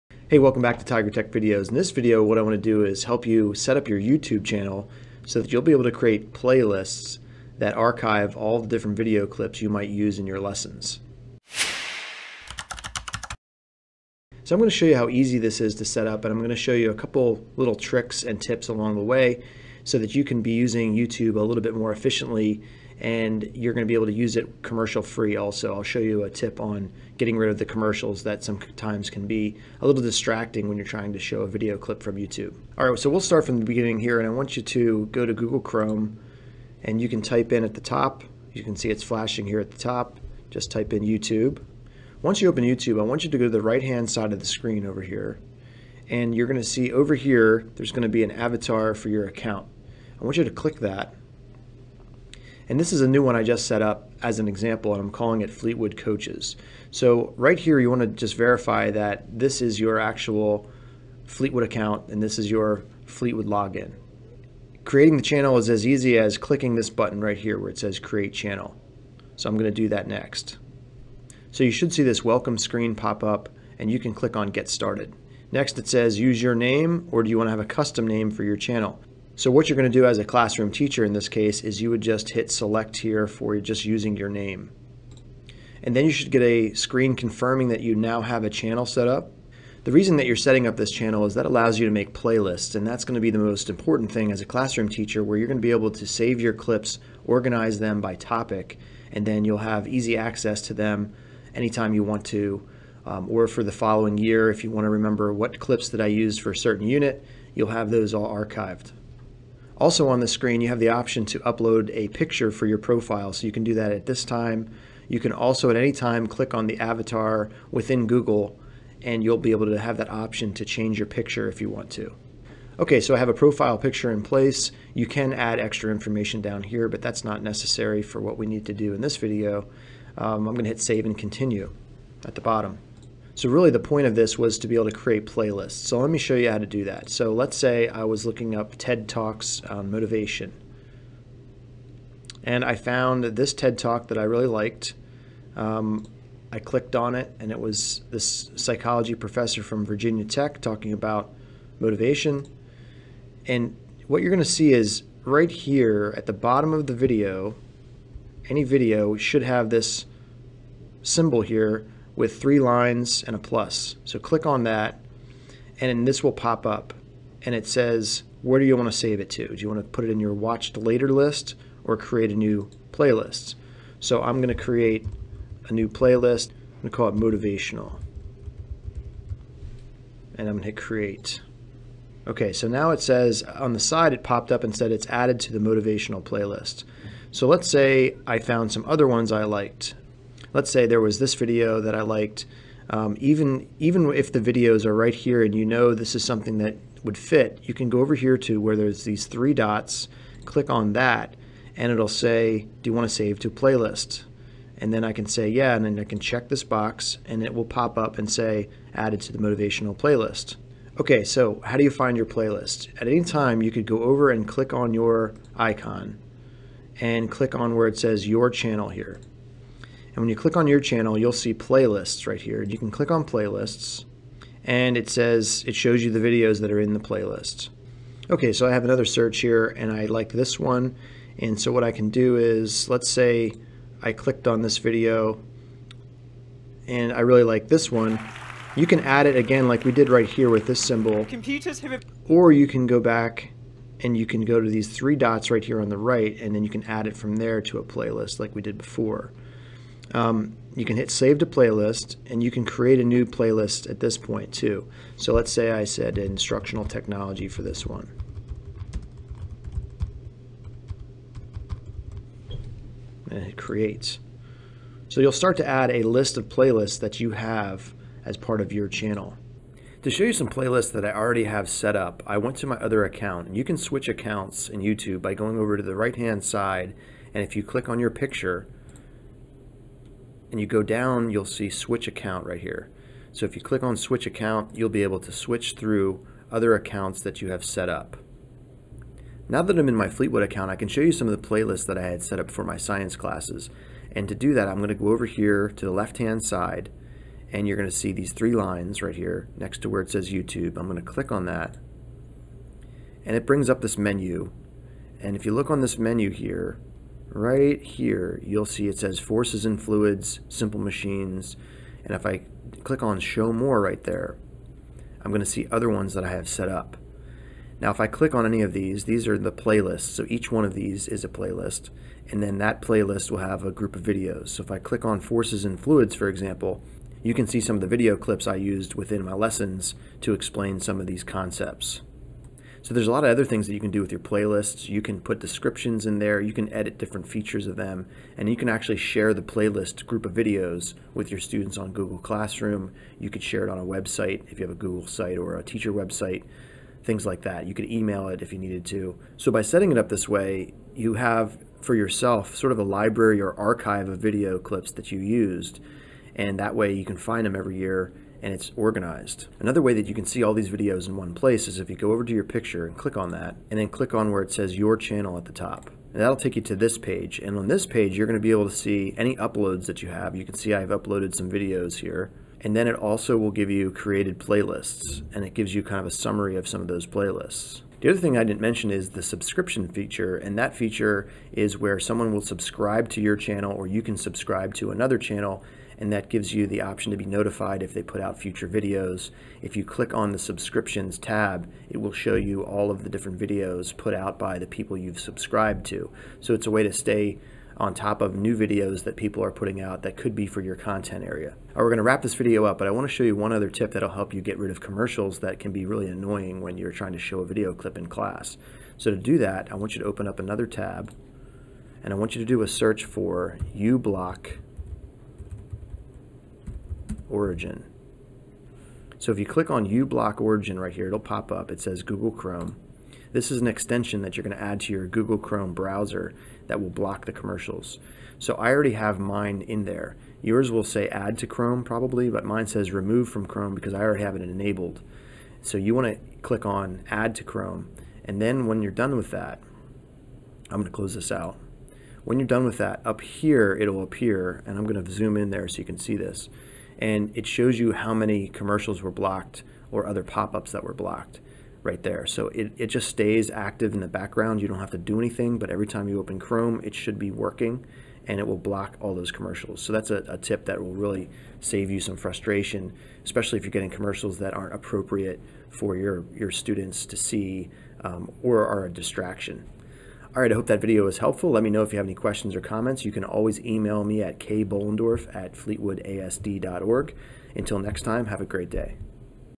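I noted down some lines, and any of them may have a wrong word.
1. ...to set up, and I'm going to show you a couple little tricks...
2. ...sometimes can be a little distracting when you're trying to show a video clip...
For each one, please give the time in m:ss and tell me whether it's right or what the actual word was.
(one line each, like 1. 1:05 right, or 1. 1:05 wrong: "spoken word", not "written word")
1. 0:15 right
2. 0:28 right.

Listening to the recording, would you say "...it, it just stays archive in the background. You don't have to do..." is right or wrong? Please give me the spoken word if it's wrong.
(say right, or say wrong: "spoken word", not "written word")
wrong: "active", not "archive".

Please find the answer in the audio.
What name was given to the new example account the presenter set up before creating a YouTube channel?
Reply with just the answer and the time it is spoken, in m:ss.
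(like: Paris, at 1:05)
Fleetwood Coaches, at 0:55.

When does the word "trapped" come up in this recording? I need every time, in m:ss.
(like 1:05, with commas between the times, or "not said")
not said.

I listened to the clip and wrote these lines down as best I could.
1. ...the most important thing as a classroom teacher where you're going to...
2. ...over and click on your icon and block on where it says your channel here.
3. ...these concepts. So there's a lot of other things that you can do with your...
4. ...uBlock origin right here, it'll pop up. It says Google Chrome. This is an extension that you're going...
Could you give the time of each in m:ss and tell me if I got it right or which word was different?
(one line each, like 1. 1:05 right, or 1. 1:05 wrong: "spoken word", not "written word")
1. 1:33 right
2. 3:34 wrong: "click", not "block"
3. 5:31 right
4. 6:59 right.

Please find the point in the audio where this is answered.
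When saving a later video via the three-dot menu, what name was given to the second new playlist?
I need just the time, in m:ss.
4:16.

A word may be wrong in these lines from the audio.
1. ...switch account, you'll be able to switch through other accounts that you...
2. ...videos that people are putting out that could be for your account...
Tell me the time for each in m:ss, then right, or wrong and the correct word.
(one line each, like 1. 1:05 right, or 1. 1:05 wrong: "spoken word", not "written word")
1. 4:43 right
2. 6:38 wrong: "content", not "account".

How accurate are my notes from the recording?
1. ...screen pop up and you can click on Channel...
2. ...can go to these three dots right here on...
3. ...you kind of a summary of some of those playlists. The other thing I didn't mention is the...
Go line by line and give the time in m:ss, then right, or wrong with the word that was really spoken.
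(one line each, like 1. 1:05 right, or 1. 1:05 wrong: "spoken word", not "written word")
1. 1:12 wrong: "Get", not "Channel"
2. 4:04 right
3. 6:15 right.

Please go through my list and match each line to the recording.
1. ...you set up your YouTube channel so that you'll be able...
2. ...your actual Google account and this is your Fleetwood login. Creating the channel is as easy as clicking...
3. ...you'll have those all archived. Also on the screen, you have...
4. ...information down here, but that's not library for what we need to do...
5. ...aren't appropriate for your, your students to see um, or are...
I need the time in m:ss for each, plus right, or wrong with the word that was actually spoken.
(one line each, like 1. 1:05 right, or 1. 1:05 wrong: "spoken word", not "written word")
1. 0:03 right
2. 0:59 wrong: "Fleetwood", not "Google"
3. 1:47 right
4. 2:05 wrong: "necessary", not "library"
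5. 7:44 right.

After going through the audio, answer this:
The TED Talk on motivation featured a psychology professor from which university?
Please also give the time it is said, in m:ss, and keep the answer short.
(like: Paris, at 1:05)
Virginia Tech, at 2:29.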